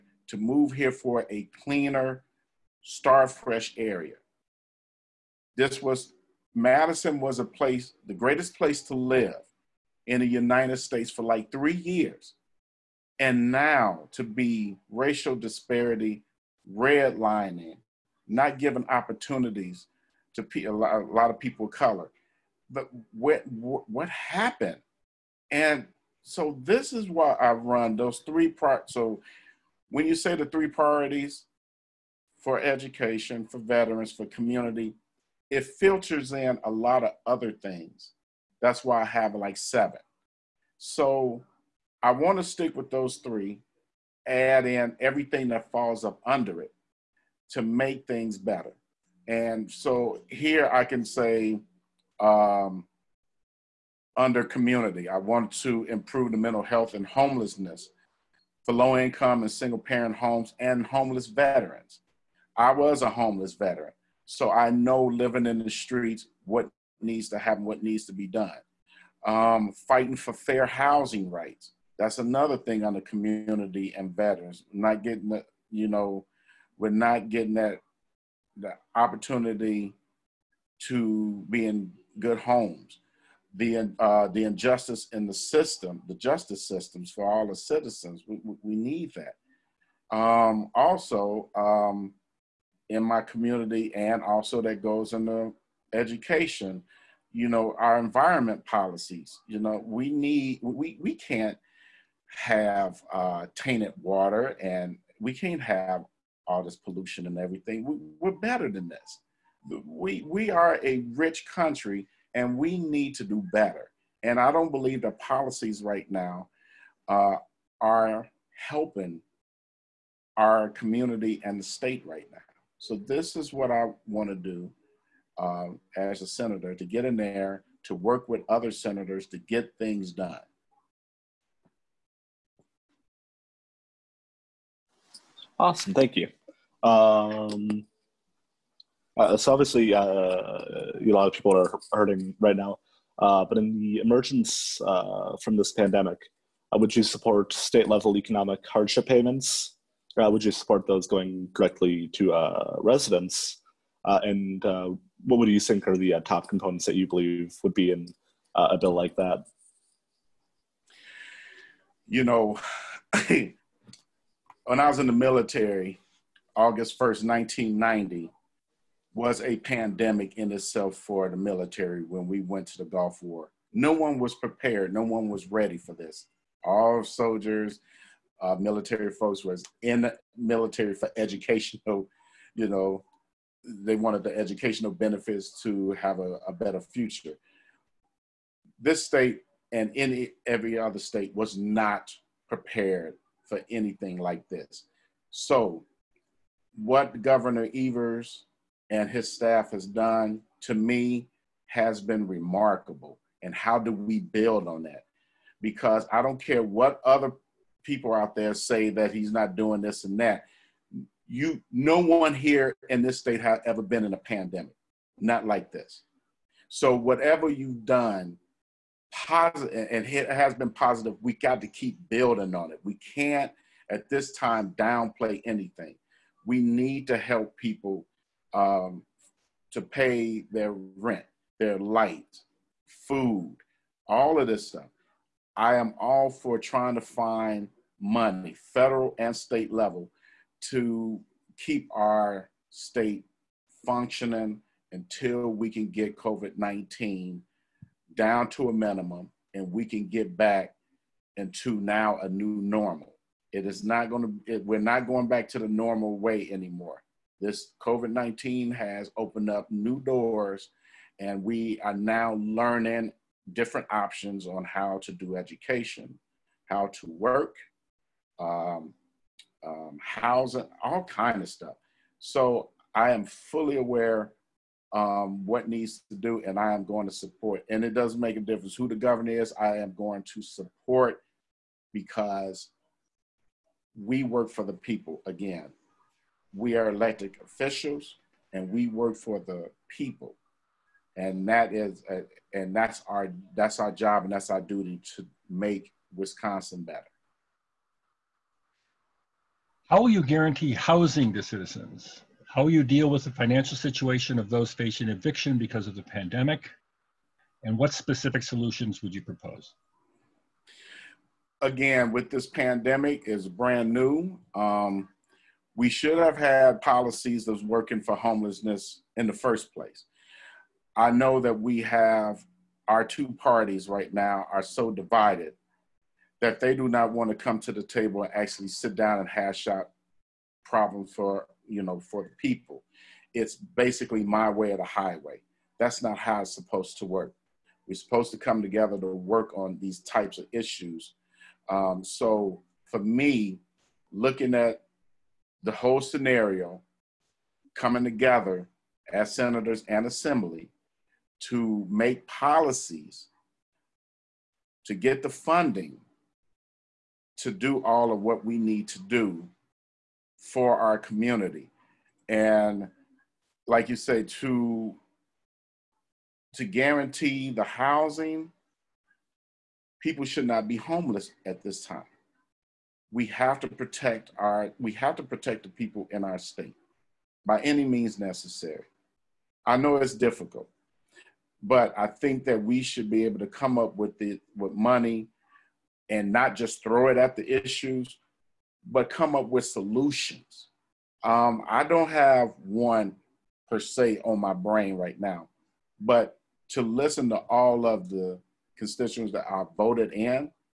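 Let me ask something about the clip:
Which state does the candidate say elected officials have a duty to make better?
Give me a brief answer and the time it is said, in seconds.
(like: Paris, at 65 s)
Wisconsin, at 296 s.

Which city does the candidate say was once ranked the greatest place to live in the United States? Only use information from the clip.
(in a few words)
Madison.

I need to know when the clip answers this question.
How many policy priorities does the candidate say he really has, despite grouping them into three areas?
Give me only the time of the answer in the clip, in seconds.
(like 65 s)
39 s.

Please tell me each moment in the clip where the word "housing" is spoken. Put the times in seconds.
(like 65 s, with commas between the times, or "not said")
70 s, 269 s, 300 s, 367 s.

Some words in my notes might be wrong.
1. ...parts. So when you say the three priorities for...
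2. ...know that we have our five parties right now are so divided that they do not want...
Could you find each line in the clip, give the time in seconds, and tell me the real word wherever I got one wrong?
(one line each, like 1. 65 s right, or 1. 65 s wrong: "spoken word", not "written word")
1. 28 s right
2. 321 s wrong: "two", not "five".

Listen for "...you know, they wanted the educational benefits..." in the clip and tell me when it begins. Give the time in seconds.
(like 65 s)
182 s.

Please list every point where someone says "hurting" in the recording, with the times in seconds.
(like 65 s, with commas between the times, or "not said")
141 s.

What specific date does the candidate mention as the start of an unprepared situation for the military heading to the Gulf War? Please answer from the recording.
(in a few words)
August 1st, 1990.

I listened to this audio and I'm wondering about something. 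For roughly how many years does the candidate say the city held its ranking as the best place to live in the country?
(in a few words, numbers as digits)
3.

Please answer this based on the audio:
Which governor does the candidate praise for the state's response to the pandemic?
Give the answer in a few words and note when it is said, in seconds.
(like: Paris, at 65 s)
Governor Evers, at 197 s.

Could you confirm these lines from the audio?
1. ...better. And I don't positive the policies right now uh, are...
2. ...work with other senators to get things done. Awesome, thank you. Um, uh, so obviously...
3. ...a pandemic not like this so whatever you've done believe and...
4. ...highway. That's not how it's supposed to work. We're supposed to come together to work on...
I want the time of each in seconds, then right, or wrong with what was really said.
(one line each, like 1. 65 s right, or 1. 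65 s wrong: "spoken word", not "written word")
1. 113 s wrong: "believe", not "positive"
2. 127 s right
3. 214 s wrong: "positive", not "believe"
4. 334 s right.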